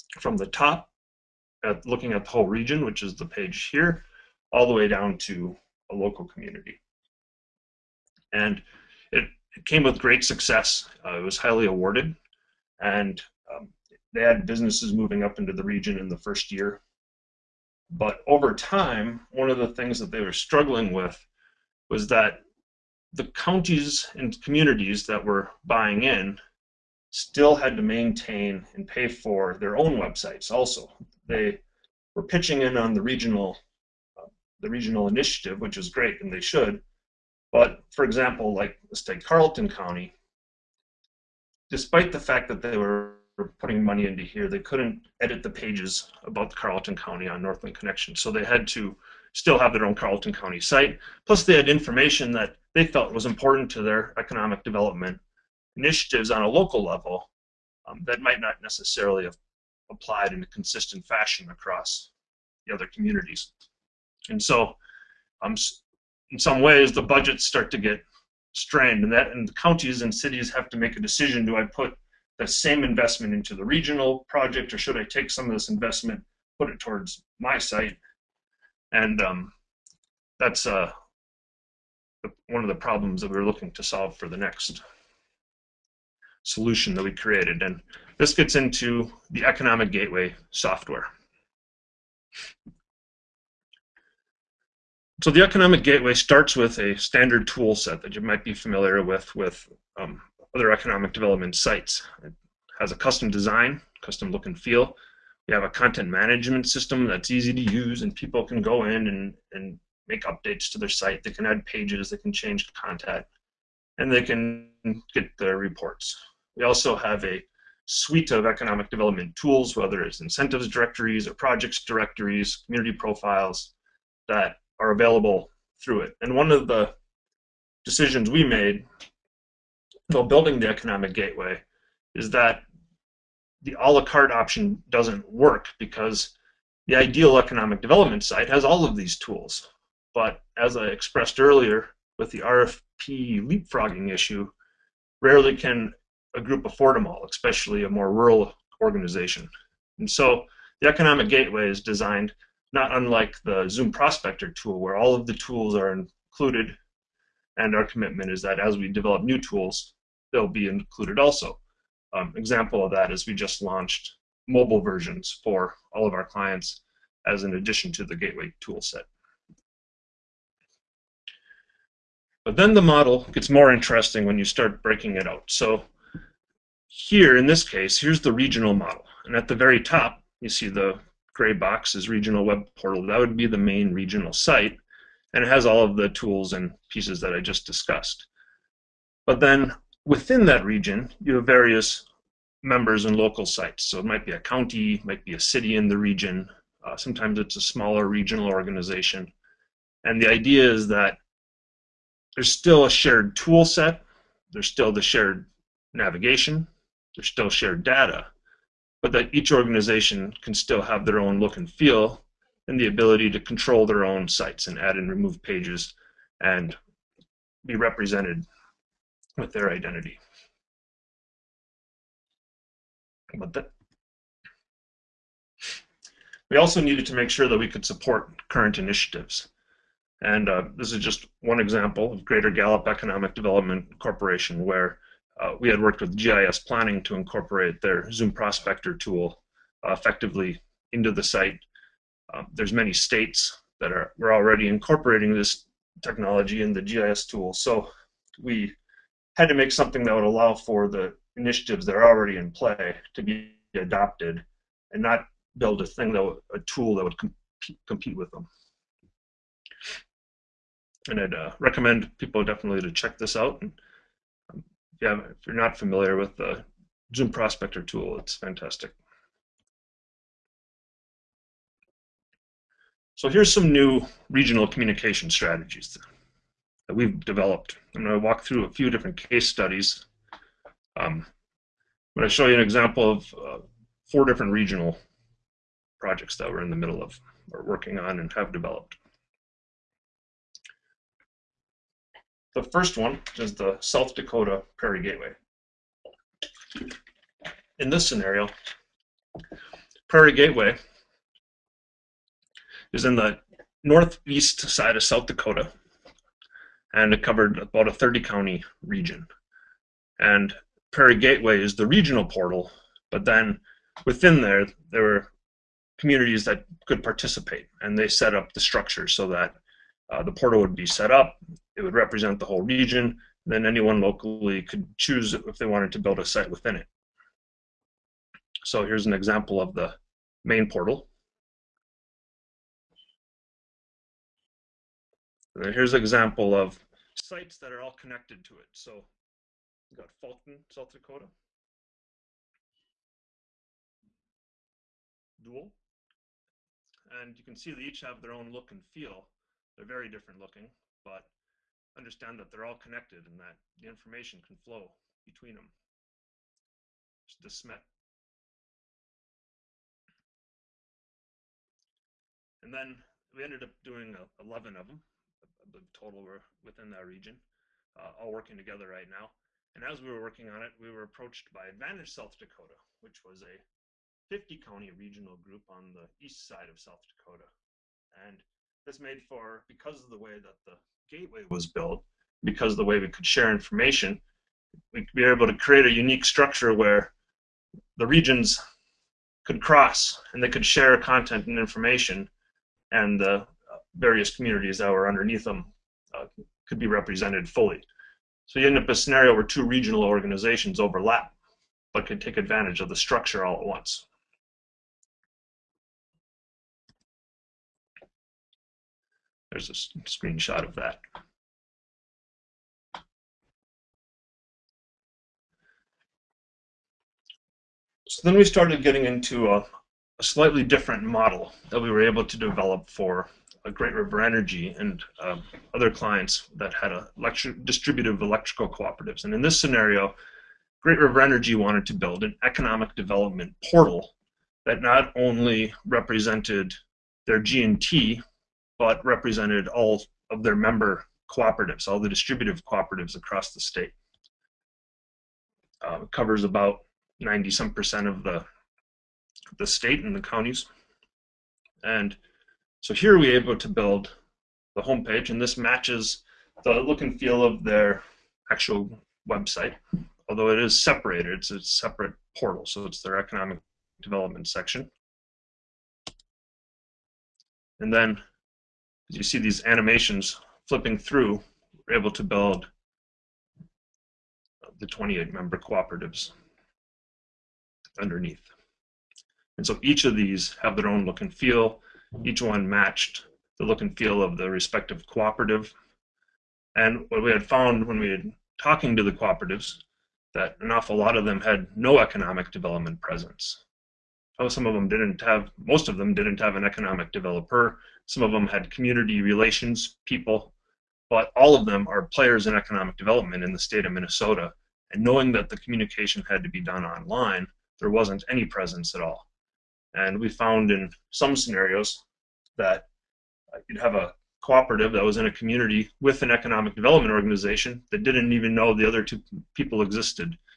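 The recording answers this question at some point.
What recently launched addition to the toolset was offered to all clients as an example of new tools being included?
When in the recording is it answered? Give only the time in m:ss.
2:44.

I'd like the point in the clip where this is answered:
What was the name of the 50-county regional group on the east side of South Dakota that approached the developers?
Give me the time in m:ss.
6:11.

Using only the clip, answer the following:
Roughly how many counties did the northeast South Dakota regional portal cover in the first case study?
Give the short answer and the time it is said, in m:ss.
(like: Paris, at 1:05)
30, at 5:07.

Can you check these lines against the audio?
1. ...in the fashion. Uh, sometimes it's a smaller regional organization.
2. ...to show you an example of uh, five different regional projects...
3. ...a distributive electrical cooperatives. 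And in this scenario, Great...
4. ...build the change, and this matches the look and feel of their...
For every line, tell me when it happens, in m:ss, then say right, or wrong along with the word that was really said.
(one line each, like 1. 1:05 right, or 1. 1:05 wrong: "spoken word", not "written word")
1. 3:15 wrong: "region", not "fashion"
2. 4:42 wrong: "four", not "five"
3. 7:06 right
4. 7:33 wrong: "homepage", not "change".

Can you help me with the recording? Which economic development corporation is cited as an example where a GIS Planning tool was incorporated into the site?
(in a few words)
Greater Gallup Economic Development Corporation.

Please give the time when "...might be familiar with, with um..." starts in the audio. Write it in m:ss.
1:38.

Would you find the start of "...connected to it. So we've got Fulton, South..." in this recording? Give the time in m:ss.
5:37.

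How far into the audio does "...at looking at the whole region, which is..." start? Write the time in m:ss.
0:01.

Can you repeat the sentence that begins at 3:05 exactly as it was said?
And it has all of the tools and pieces that I just discussed.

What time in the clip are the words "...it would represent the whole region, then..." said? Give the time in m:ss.
5:21.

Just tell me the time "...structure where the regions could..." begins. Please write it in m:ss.
6:26.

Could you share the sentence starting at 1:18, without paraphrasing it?
And um, that's uh, one of the problems that we are looking to solve for the next solution that we created.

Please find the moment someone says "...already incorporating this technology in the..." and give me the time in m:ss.
4:04.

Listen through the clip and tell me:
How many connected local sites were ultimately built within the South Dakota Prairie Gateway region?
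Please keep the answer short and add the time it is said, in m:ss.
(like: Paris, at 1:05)
11, at 6:04.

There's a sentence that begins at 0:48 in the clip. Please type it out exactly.
So they had to still have their own Carlton County site.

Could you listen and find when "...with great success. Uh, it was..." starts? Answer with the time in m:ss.
0:09.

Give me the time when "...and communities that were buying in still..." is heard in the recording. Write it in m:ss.
0:24.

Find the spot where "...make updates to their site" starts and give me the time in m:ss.
1:50.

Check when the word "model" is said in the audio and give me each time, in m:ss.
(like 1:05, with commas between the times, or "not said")
2:52, 2:58, 7:01.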